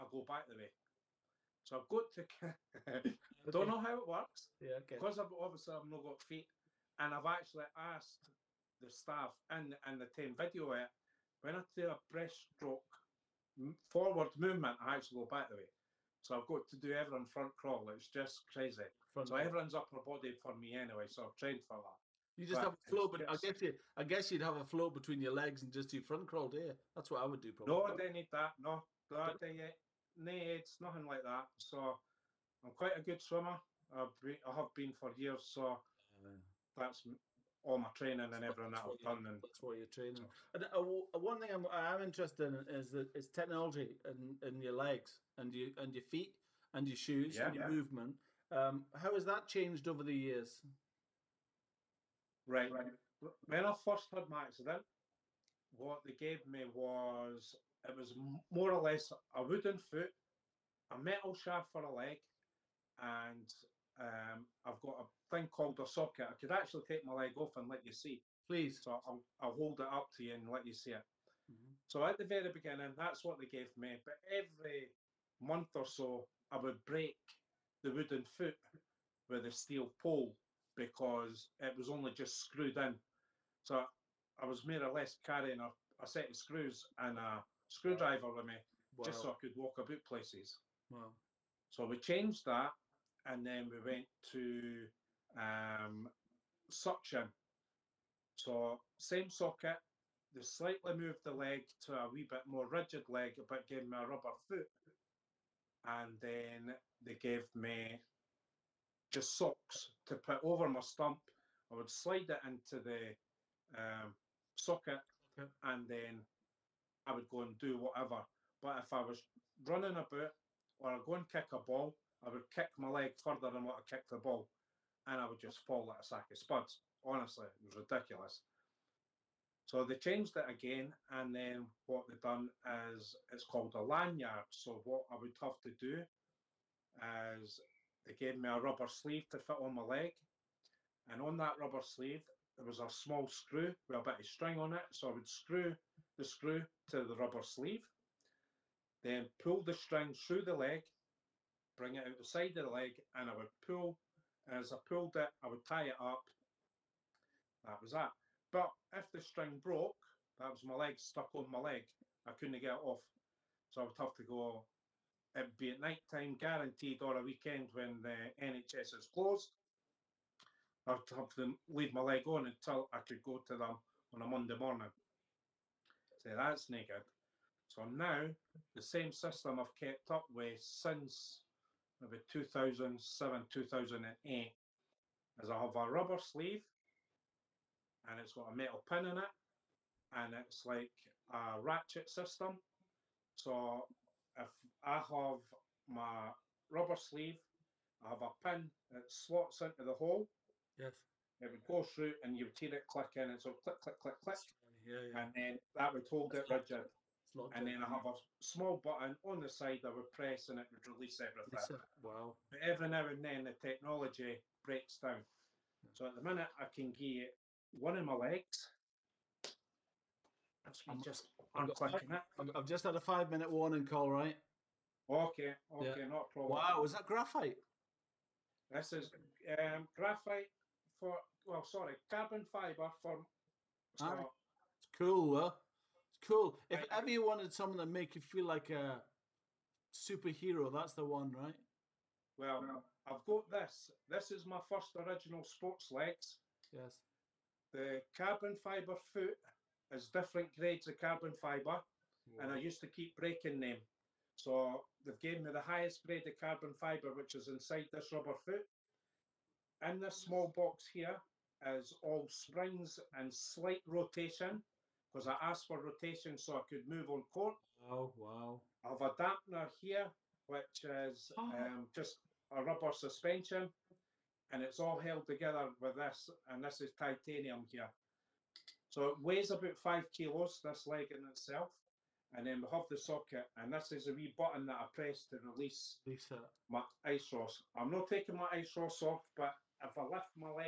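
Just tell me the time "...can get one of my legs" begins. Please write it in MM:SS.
03:36.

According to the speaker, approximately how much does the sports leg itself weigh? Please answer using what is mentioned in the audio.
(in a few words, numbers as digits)
5 kilos.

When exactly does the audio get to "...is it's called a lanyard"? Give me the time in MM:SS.
02:12.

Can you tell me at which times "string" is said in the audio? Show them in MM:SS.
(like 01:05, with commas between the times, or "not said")
02:24, 02:29, 02:39.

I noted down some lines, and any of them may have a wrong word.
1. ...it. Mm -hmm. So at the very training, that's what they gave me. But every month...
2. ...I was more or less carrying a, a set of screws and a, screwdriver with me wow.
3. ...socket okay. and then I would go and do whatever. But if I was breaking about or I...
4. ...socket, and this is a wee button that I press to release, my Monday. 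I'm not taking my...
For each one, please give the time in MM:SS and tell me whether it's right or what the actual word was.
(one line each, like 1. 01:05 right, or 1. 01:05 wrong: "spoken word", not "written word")
1. 01:10 wrong: "beginning", not "training"
2. 01:24 right
3. 01:54 wrong: "running", not "breaking"
4. 04:42 wrong: "Iceross", not "Monday".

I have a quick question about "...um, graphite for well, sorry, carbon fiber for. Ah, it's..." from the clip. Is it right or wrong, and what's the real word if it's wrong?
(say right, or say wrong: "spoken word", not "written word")
right.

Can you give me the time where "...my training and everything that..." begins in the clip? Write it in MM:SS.
00:37.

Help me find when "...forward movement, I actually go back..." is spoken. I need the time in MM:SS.
00:13.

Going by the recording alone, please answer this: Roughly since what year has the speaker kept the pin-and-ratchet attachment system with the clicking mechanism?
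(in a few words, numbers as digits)
2007.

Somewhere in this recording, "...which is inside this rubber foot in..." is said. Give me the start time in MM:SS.
04:17.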